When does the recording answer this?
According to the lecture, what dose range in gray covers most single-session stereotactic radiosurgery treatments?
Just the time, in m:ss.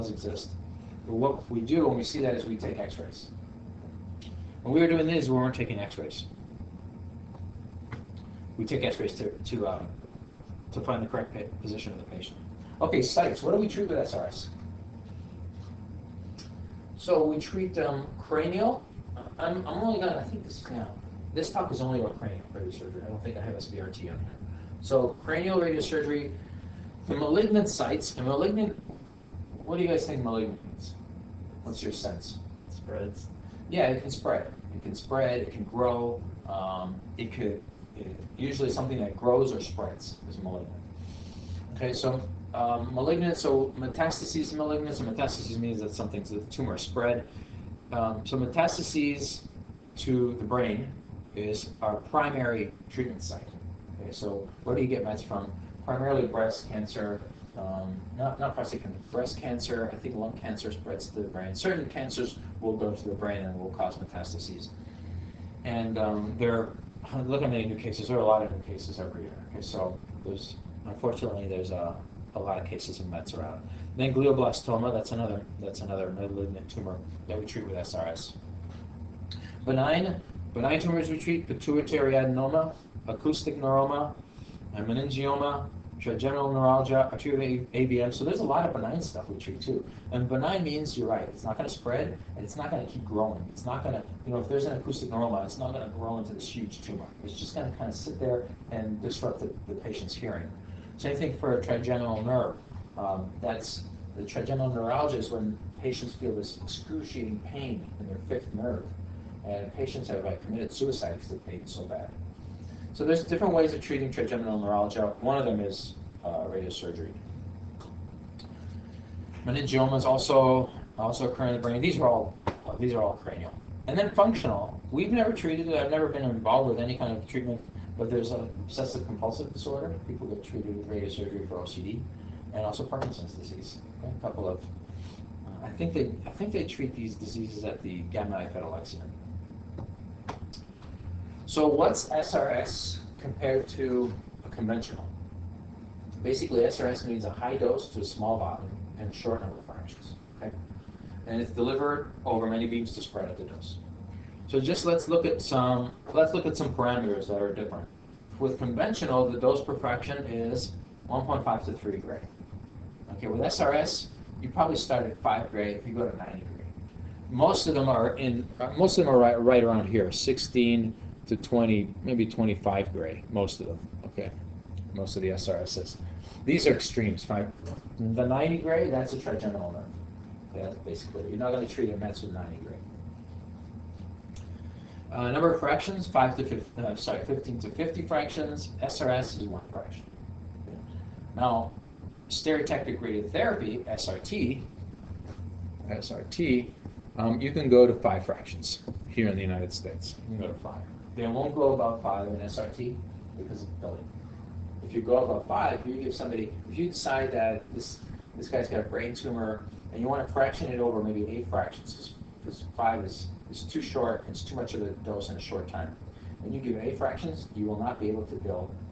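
2:50.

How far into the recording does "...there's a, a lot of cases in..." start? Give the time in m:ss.
1:11.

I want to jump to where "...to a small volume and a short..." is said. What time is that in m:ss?
2:27.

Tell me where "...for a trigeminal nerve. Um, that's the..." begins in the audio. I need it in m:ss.
1:41.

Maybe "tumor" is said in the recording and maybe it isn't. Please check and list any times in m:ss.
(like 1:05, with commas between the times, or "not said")
0:46, 1:16, 1:20, 1:36, 3:29.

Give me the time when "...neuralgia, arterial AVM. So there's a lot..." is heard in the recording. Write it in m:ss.
1:26.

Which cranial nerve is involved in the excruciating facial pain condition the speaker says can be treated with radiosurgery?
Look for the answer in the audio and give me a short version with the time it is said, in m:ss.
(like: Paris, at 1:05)
Fifth nerve, at 1:48.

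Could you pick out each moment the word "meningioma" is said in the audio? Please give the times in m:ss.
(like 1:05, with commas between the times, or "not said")
1:24, 1:59.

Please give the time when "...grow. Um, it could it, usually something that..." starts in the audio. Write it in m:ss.
0:35.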